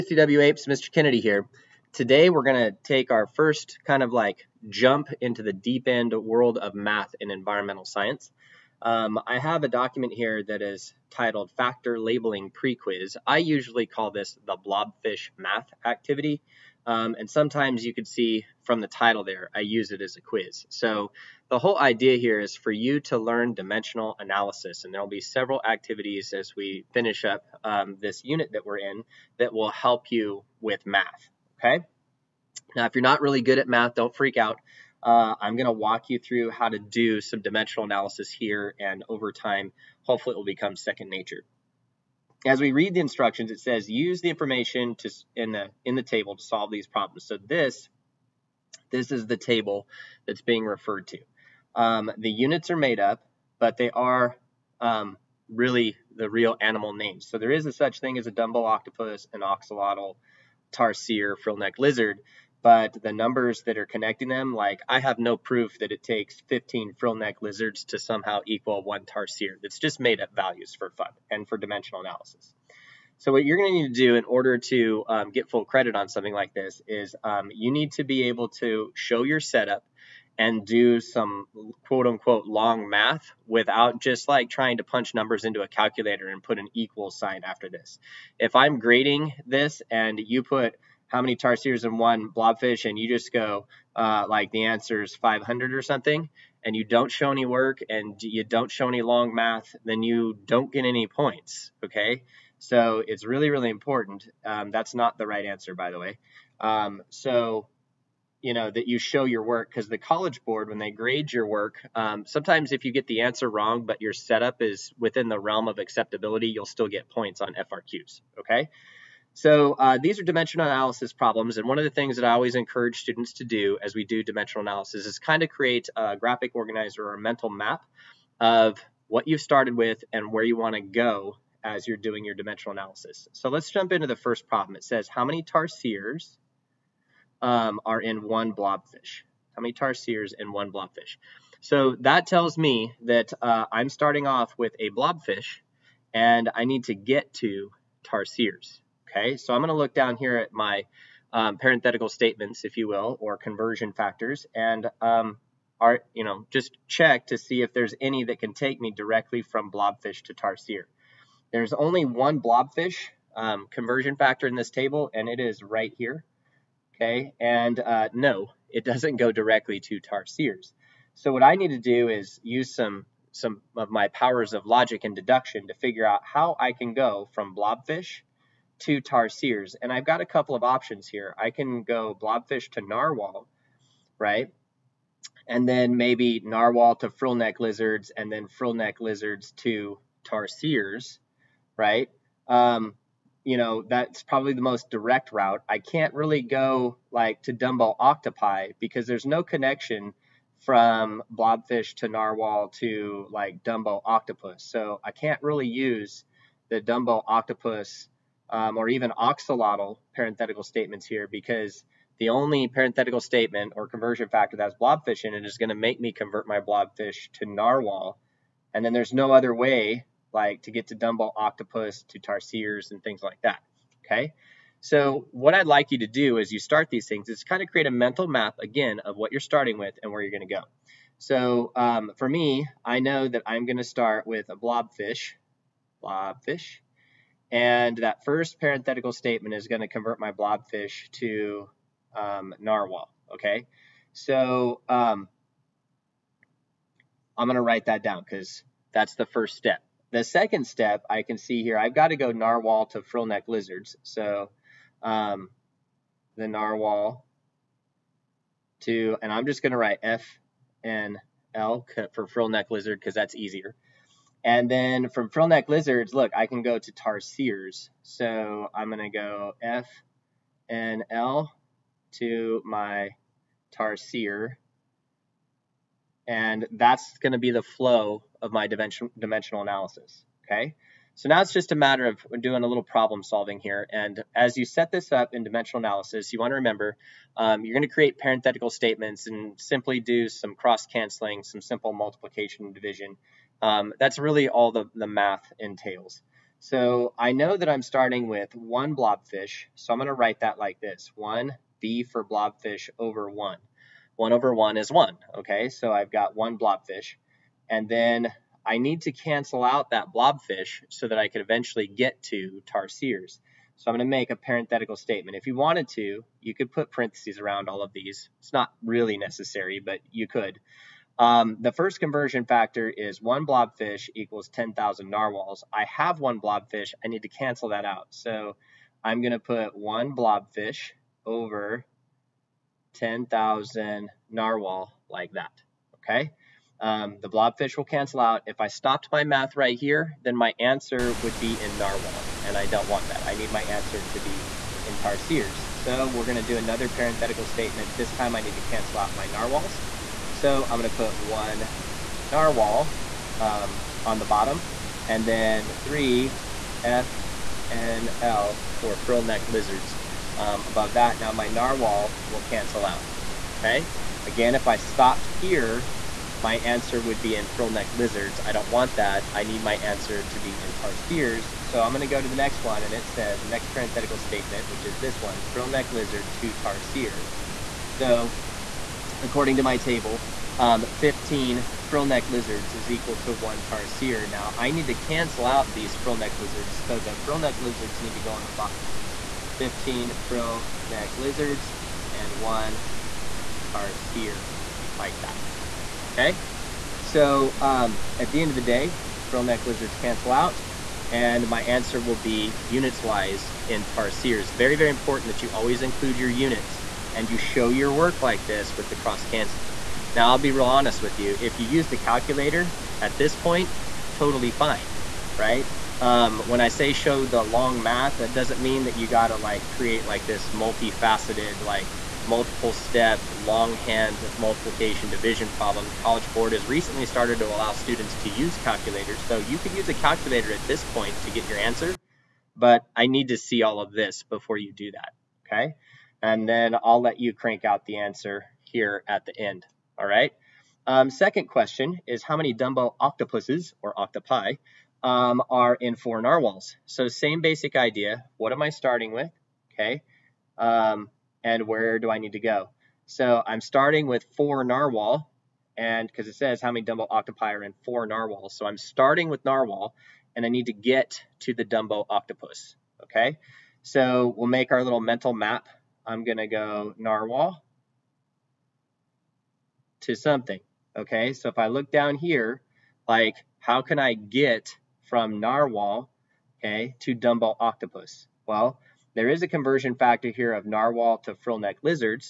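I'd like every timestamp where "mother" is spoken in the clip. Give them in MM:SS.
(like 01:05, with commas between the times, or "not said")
not said.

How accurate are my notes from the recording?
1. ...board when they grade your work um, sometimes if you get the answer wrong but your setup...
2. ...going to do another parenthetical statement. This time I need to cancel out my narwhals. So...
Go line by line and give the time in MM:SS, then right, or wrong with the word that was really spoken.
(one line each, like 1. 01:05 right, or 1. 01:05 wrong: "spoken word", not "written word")
1. 01:50 right
2. 05:46 right.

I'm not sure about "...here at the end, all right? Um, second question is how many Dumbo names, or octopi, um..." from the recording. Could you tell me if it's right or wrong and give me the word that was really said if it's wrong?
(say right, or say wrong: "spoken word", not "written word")
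wrong: "octopuses", not "names".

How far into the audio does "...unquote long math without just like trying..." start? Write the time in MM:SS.
01:22.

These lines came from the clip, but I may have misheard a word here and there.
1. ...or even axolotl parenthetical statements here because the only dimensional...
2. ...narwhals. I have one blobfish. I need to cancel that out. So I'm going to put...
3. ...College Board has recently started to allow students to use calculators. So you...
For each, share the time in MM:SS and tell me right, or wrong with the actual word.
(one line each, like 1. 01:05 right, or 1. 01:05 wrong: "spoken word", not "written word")
1. 03:28 wrong: "parenthetical", not "dimensional"
2. 05:25 right
3. 07:05 right.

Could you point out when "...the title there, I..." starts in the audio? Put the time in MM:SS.
00:18.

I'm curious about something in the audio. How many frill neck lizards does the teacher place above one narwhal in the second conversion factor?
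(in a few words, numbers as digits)
3.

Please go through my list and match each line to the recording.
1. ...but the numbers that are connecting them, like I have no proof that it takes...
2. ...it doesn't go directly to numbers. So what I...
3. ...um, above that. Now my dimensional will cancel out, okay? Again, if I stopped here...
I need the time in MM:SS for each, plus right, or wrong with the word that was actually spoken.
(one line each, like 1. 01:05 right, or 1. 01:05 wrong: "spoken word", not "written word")
1. 01:02 right
2. 02:48 wrong: "tarsiers", not "numbers"
3. 06:00 wrong: "narwhal", not "dimensional".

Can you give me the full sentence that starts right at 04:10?
The second step I can see here, I've got to go narwhal to frill neck lizards.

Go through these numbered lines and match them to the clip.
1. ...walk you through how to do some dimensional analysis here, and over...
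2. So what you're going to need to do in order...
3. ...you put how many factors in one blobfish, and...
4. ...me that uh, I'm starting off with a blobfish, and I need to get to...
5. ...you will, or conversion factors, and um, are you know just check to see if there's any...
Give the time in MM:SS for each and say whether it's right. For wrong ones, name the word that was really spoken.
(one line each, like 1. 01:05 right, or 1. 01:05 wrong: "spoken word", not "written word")
1. 00:35 right
2. 01:13 right
3. 01:30 wrong: "tarsiers", not "factors"
4. 02:22 right
5. 02:32 right.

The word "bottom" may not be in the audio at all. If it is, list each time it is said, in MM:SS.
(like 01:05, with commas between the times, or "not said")
05:54, 06:28.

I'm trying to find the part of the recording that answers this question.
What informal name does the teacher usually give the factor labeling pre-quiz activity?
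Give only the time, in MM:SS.
00:14.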